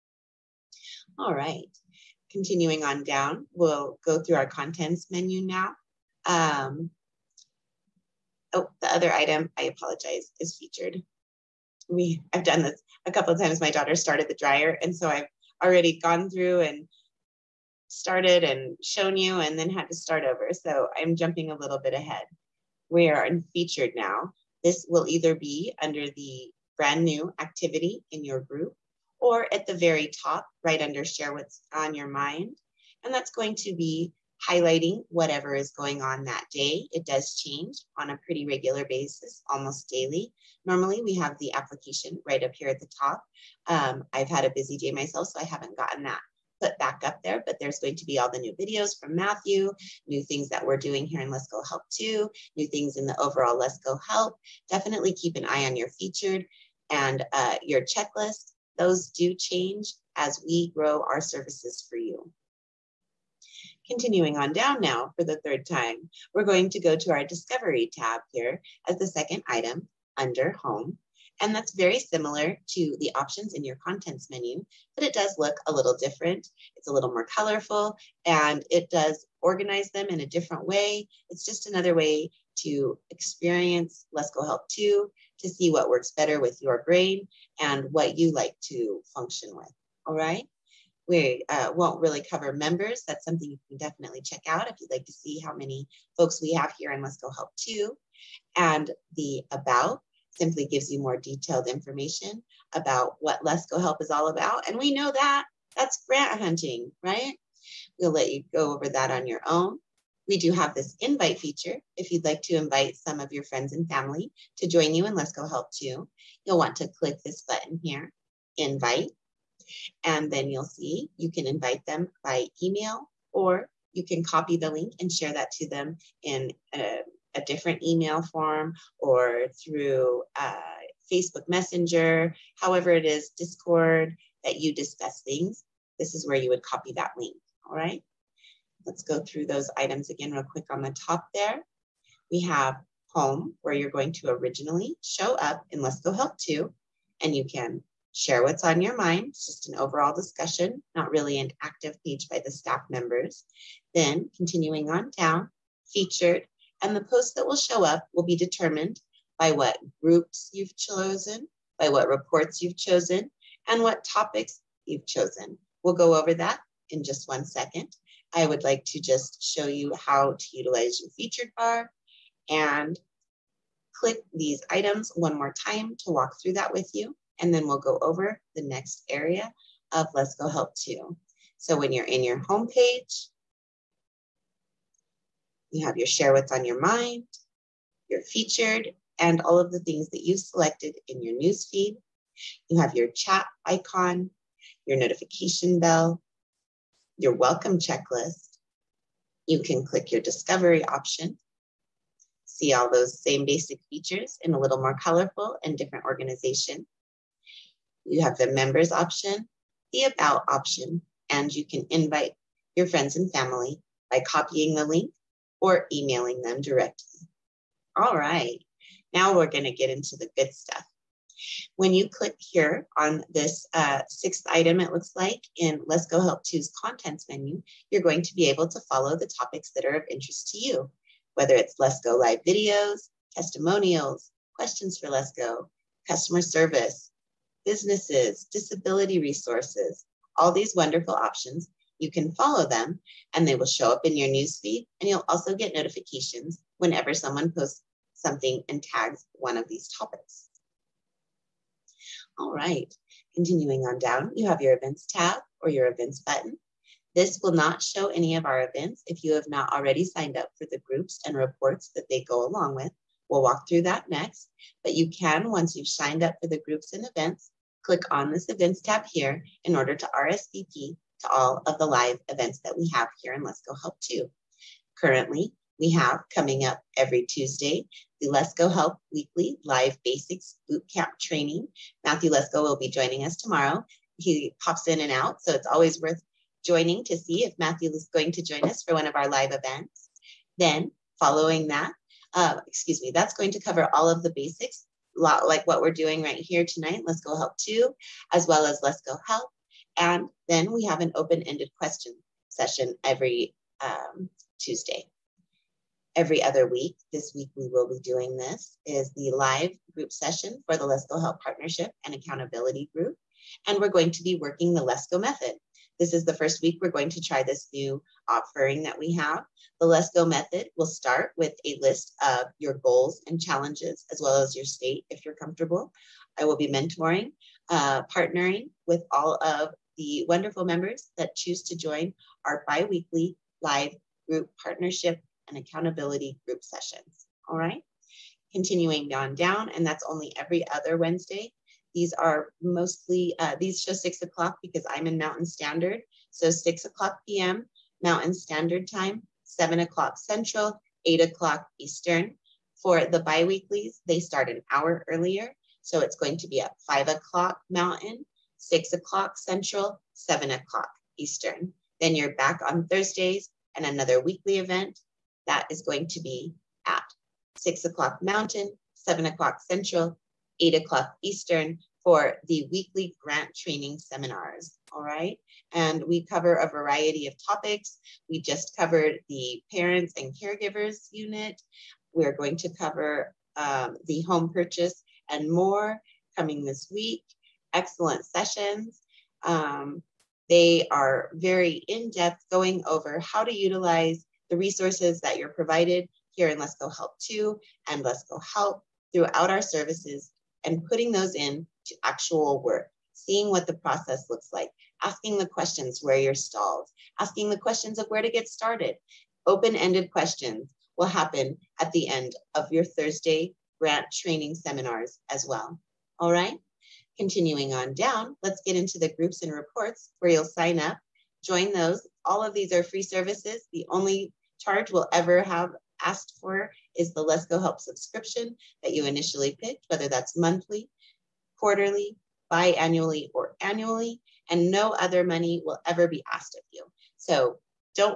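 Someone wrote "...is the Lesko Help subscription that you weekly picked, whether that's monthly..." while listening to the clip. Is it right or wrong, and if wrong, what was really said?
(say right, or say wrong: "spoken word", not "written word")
wrong: "initially", not "weekly".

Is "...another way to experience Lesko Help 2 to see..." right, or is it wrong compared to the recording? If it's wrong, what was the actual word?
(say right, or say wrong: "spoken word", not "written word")
right.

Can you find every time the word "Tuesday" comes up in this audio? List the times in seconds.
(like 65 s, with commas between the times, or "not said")
277 s, 304 s.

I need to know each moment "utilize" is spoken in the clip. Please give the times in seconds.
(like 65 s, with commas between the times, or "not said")
170 s, 393 s.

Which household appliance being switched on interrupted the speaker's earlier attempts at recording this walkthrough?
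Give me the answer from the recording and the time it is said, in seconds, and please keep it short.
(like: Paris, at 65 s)
Dryer, at 14 s.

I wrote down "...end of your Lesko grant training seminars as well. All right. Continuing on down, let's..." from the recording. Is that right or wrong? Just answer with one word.
wrong.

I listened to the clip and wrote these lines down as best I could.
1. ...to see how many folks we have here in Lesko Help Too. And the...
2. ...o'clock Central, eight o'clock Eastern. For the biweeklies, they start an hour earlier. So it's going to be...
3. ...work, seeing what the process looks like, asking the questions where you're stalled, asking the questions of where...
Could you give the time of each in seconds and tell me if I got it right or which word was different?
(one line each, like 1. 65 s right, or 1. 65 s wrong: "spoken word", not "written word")
1. 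95 s right
2. 349 s right
3. 402 s right.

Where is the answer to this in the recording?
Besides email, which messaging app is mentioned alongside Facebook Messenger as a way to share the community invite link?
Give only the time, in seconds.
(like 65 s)
133 s.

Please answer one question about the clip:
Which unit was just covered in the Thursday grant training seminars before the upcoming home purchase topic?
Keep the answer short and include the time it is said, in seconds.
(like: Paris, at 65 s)
Parents and caregivers, at 379 s.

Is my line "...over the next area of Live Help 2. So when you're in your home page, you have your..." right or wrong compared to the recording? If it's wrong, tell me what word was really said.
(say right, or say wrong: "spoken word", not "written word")
wrong: "Lesko", not "Live".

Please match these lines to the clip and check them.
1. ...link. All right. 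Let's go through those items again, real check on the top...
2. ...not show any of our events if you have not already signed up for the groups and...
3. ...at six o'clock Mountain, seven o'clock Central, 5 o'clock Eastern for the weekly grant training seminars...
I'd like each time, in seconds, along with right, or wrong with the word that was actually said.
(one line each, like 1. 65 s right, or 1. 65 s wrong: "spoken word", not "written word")
1. 137 s wrong: "quick", not "check"
2. 257 s right
3. 366 s wrong: "8", not "5".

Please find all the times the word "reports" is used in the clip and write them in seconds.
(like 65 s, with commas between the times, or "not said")
162 s, 261 s, 419 s.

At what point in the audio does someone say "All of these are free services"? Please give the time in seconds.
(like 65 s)
422 s.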